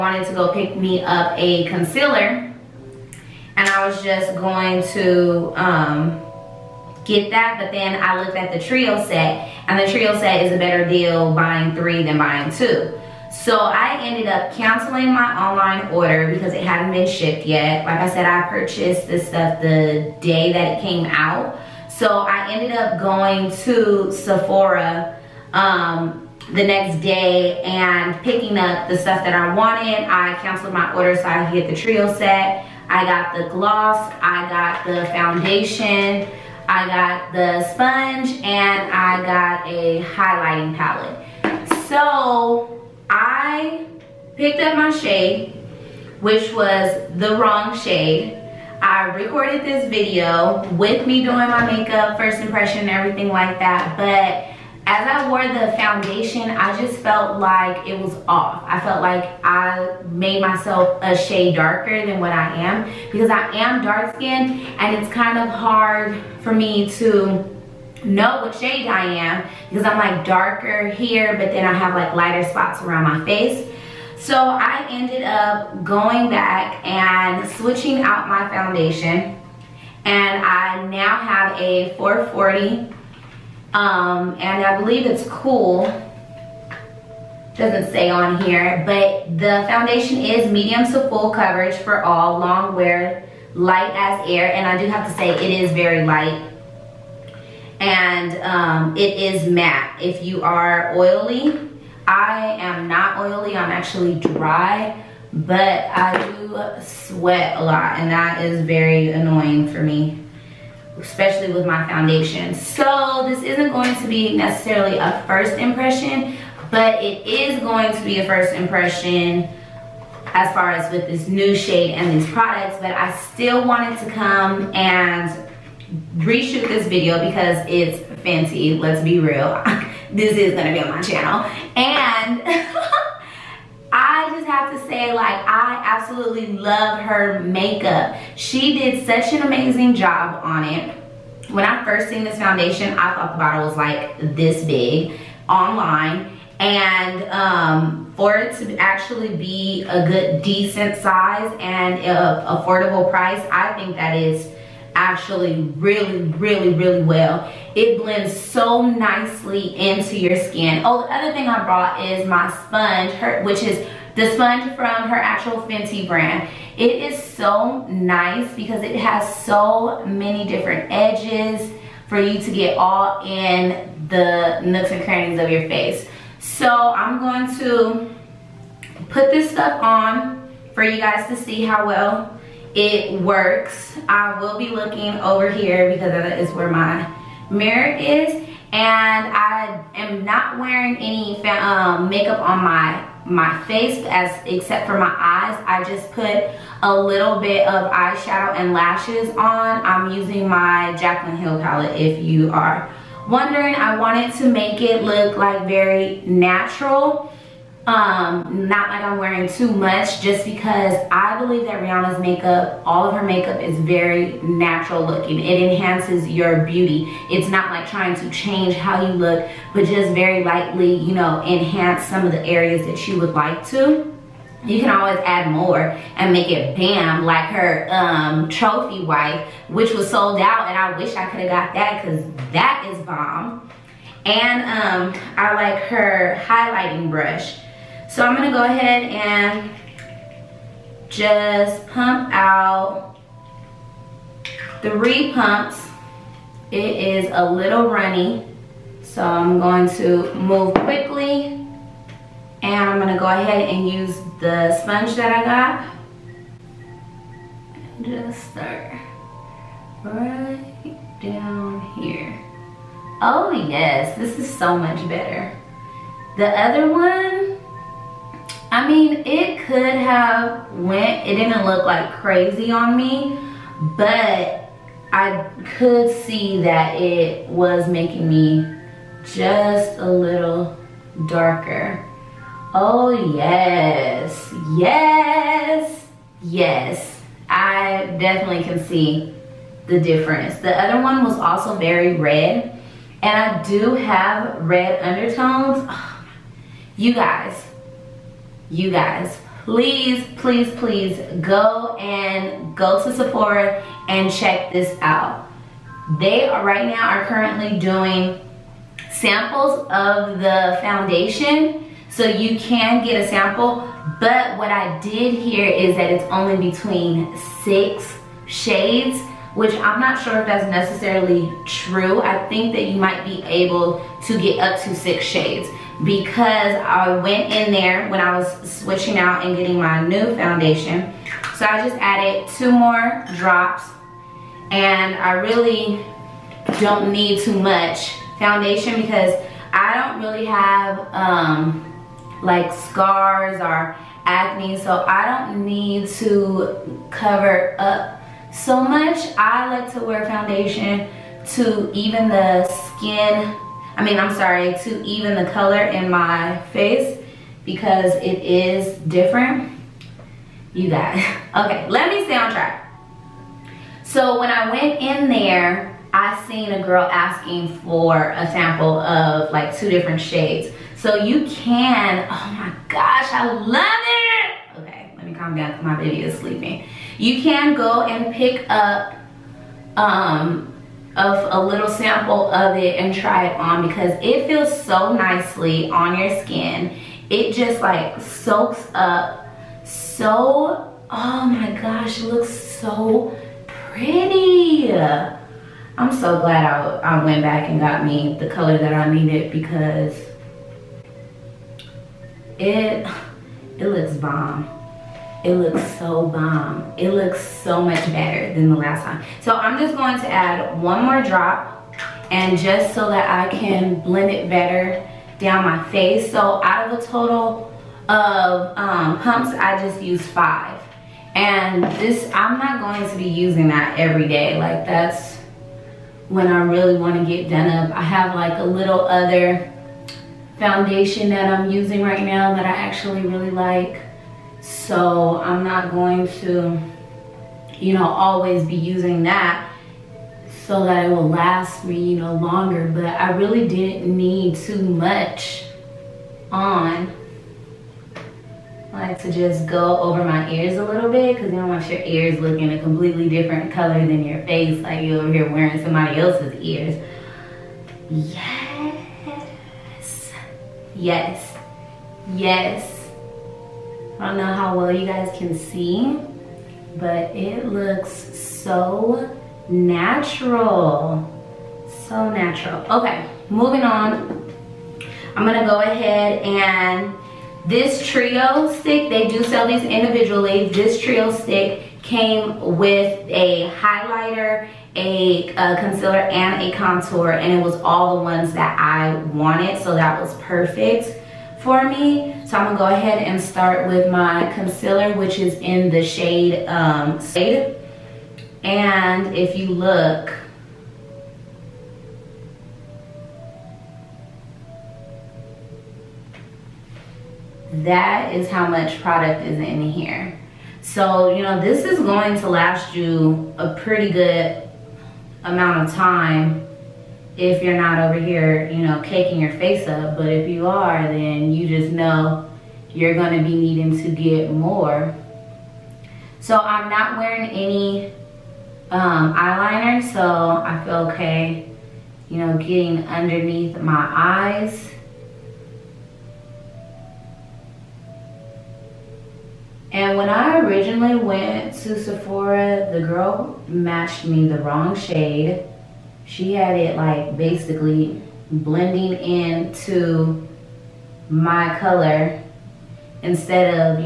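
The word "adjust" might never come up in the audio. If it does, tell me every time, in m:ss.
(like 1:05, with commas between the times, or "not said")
not said.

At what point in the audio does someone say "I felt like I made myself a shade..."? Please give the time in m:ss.
0:58.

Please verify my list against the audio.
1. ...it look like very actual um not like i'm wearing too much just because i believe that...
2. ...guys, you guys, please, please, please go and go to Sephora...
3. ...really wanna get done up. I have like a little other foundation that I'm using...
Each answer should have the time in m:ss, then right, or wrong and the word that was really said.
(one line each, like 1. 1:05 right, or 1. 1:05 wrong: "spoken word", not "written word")
1. 3:24 wrong: "natural", not "actual"
2. 4:57 right
3. 7:06 right.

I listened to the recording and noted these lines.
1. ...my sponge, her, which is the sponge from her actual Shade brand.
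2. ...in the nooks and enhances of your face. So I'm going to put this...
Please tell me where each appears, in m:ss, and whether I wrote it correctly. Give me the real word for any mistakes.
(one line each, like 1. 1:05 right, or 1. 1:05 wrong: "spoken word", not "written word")
1. 2:42 wrong: "Fenty", not "Shade"
2. 2:53 wrong: "crannies", not "enhances".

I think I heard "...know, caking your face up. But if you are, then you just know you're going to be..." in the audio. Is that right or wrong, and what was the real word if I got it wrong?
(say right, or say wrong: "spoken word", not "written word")
right.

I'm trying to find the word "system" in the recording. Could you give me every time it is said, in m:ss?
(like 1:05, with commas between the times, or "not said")
not said.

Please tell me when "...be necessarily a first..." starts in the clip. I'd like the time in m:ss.
1:54.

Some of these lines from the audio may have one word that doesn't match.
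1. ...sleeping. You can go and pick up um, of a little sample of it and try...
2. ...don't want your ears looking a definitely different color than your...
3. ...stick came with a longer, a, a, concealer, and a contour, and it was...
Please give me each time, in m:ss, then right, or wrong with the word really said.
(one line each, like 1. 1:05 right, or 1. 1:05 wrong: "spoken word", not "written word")
1. 6:16 right
2. 7:31 wrong: "completely", not "definitely"
3. 8:01 wrong: "highlighter", not "longer".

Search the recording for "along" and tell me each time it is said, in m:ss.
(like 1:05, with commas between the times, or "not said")
not said.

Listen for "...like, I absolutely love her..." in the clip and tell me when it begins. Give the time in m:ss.
2:15.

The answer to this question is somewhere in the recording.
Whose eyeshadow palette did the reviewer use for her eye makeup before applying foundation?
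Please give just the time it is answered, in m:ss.
3:20.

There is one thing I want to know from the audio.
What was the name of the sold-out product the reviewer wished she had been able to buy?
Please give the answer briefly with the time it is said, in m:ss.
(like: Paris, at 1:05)
Trophy Wife, at 3:48.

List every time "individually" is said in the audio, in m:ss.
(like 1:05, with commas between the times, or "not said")
7:59.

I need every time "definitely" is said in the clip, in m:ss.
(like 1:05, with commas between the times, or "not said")
4:48.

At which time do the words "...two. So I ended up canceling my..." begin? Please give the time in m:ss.
0:12.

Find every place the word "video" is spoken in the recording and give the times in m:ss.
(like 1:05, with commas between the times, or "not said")
0:49, 2:06.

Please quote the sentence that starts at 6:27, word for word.
It just like soaks up so, oh my gosh, it looks so pretty.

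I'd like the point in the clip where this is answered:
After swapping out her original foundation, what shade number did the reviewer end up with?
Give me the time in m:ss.
1:21.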